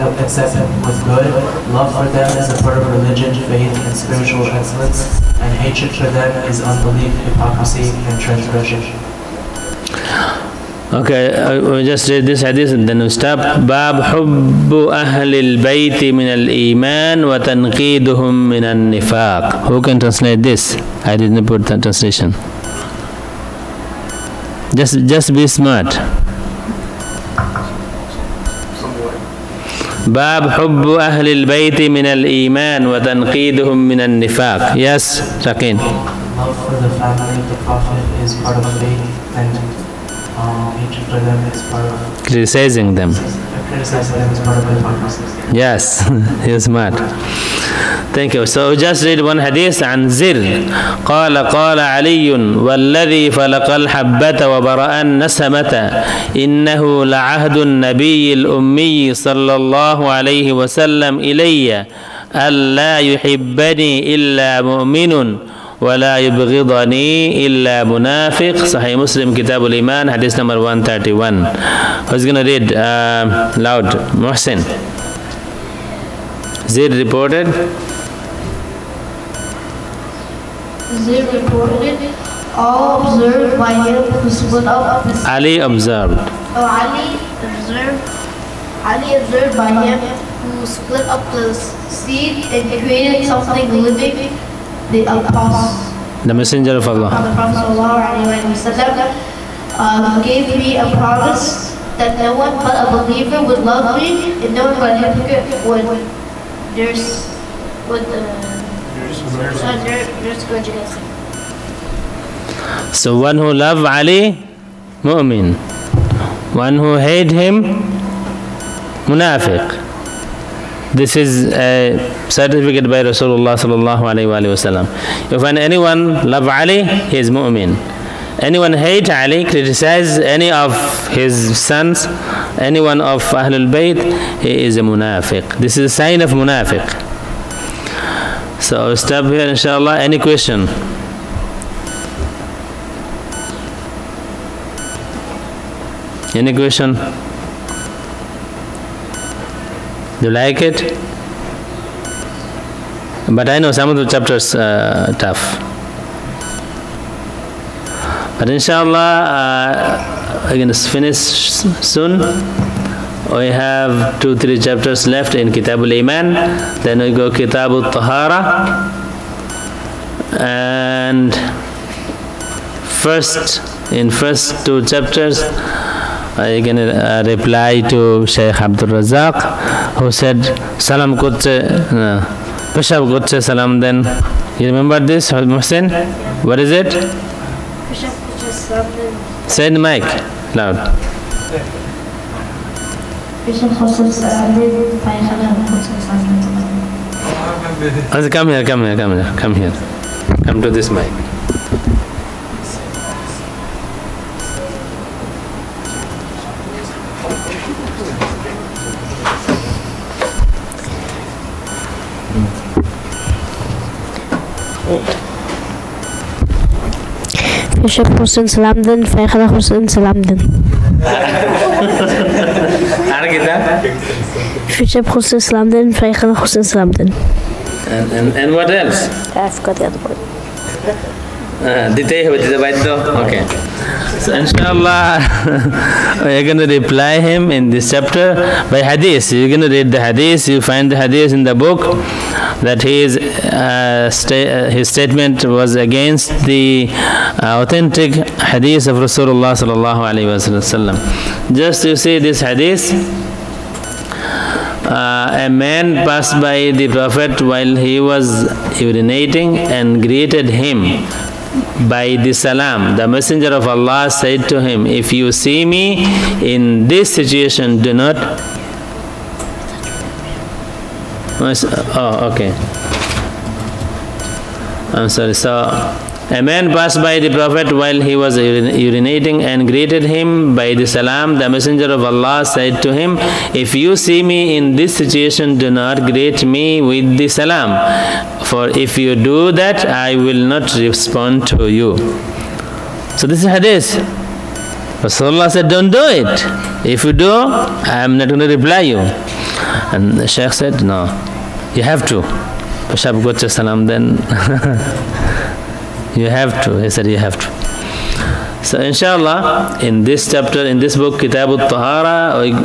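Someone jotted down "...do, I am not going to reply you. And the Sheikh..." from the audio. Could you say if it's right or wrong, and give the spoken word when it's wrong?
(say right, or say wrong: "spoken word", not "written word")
right.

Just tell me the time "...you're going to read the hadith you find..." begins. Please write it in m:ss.
3:59.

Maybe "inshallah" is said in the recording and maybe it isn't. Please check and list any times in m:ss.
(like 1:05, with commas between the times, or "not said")
2:19, 2:38, 3:54, 5:08.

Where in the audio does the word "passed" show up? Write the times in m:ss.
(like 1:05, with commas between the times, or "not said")
4:16, 4:36.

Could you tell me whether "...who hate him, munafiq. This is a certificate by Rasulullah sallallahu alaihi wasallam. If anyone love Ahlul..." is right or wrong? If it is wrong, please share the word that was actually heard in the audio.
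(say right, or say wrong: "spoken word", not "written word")
wrong: "Ali", not "Ahlul".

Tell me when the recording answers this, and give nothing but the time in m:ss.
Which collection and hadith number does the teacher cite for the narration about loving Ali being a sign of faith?
1:08.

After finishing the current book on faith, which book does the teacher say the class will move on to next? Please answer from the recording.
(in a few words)
Kitabul Tahara.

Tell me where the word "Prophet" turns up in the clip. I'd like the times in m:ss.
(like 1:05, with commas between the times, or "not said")
0:37, 1:37, 4:16, 4:37.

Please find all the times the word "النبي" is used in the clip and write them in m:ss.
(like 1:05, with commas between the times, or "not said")
0:57.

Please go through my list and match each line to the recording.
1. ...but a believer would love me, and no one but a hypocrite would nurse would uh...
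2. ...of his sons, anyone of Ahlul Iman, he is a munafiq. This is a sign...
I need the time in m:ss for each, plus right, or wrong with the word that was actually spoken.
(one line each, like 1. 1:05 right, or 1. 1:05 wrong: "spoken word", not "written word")
1. 1:42 right
2. 2:10 wrong: "Bayt", not "Iman".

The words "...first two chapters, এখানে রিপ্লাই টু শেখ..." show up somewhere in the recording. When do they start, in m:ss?
2:54.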